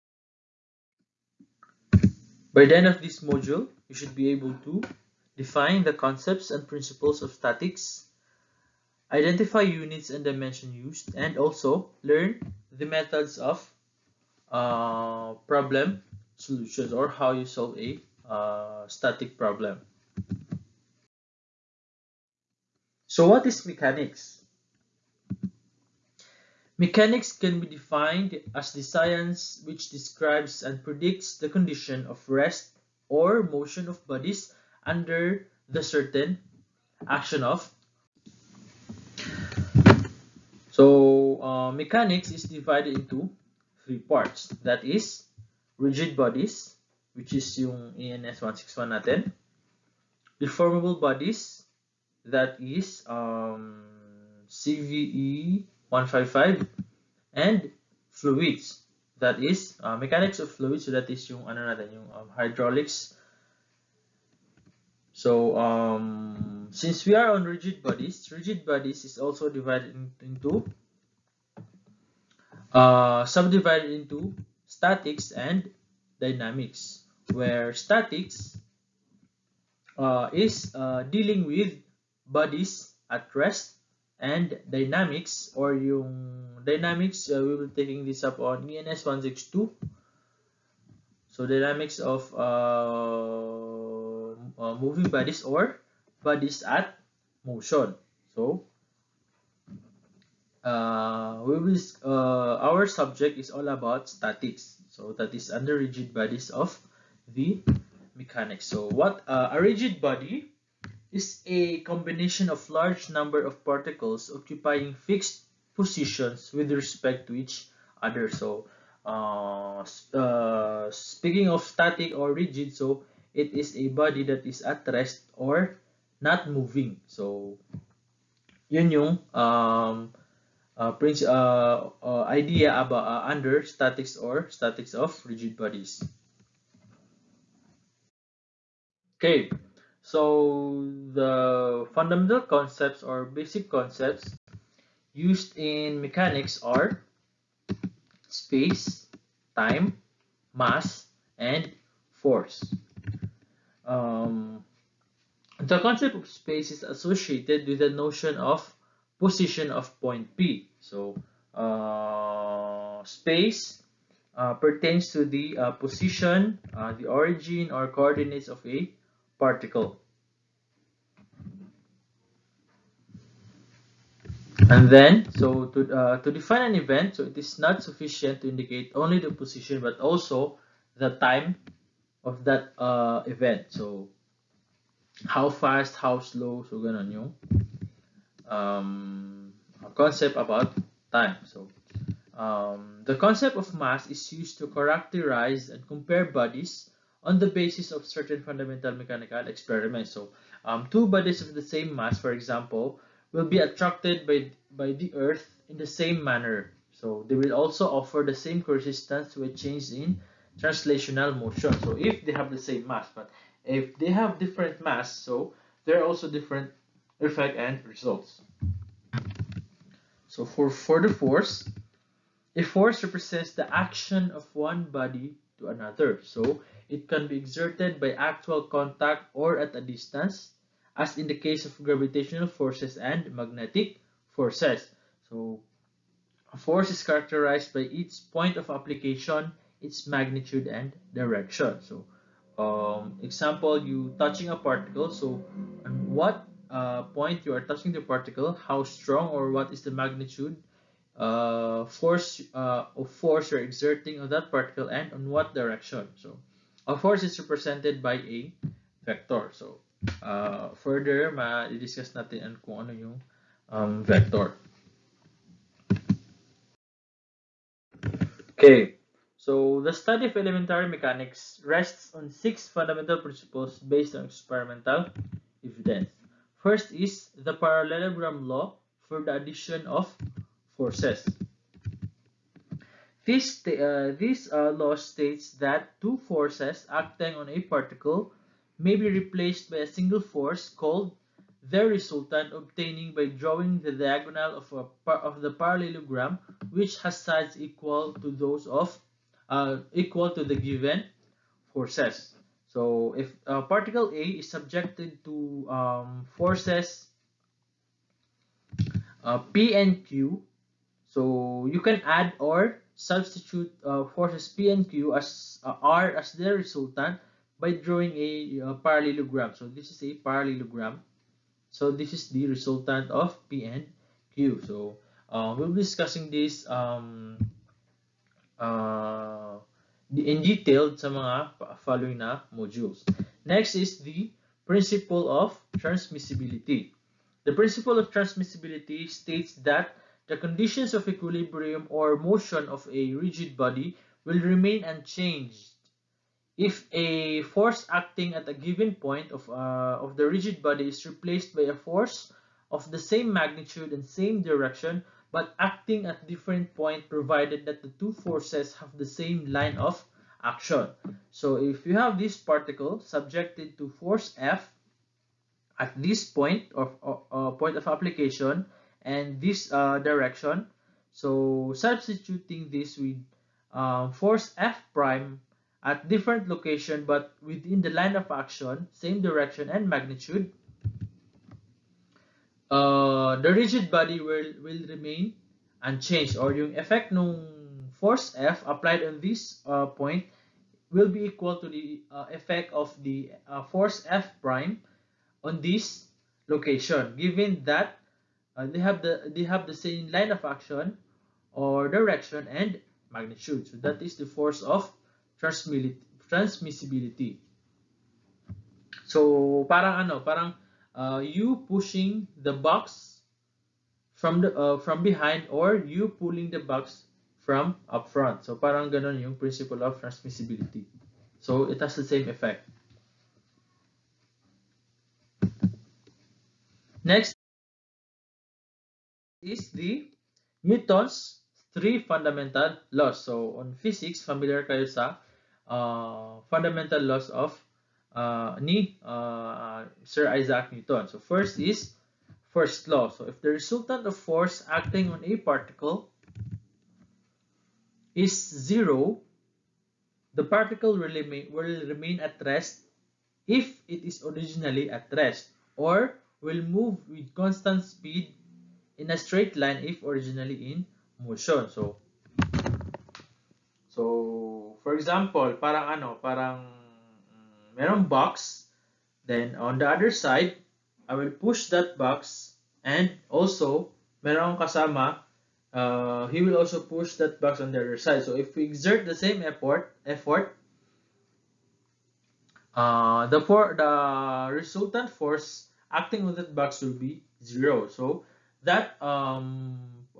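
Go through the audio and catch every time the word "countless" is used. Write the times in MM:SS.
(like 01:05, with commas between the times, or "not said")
not said.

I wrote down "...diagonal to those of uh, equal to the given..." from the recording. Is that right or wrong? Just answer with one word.
wrong.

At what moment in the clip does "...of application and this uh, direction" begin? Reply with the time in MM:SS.
06:07.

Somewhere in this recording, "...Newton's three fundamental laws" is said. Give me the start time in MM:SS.
07:10.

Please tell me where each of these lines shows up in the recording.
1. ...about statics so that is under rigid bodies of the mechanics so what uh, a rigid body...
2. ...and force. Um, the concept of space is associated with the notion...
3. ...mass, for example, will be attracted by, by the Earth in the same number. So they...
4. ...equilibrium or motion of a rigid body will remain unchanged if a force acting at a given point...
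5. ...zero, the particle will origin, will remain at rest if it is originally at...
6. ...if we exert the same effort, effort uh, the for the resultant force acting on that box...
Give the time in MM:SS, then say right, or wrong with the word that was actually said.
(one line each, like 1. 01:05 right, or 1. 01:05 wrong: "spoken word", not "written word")
1. 01:43 right
2. 02:31 right
3. 03:21 wrong: "manner", not "number"
4. 05:41 right
5. 07:28 wrong: "remain", not "origin"
6. 07:58 right.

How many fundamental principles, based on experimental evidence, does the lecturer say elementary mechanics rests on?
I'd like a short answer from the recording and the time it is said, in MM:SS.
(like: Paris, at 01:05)
6, at 04:32.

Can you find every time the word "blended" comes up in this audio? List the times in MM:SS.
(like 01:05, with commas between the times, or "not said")
not said.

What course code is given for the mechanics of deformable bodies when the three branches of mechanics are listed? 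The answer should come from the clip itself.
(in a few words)
CVE 155.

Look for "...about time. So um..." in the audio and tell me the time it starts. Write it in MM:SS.
03:10.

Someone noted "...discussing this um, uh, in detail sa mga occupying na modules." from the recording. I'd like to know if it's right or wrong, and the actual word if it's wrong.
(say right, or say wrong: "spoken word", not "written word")
wrong: "following", not "occupying".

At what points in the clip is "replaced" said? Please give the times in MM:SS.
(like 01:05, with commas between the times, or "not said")
04:49, 05:51.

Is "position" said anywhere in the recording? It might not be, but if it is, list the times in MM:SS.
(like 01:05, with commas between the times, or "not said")
01:55, 02:39, 02:45, 02:59.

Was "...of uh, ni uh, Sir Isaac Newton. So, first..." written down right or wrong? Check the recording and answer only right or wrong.
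right.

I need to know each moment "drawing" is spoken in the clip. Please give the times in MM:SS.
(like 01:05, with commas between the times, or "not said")
04:53, 05:17.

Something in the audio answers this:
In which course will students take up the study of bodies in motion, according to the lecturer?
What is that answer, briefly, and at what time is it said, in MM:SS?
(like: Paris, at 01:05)
ENS 162, at 01:28.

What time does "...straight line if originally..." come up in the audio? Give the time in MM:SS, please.
07:39.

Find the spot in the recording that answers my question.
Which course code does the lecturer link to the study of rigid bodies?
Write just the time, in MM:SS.
00:48.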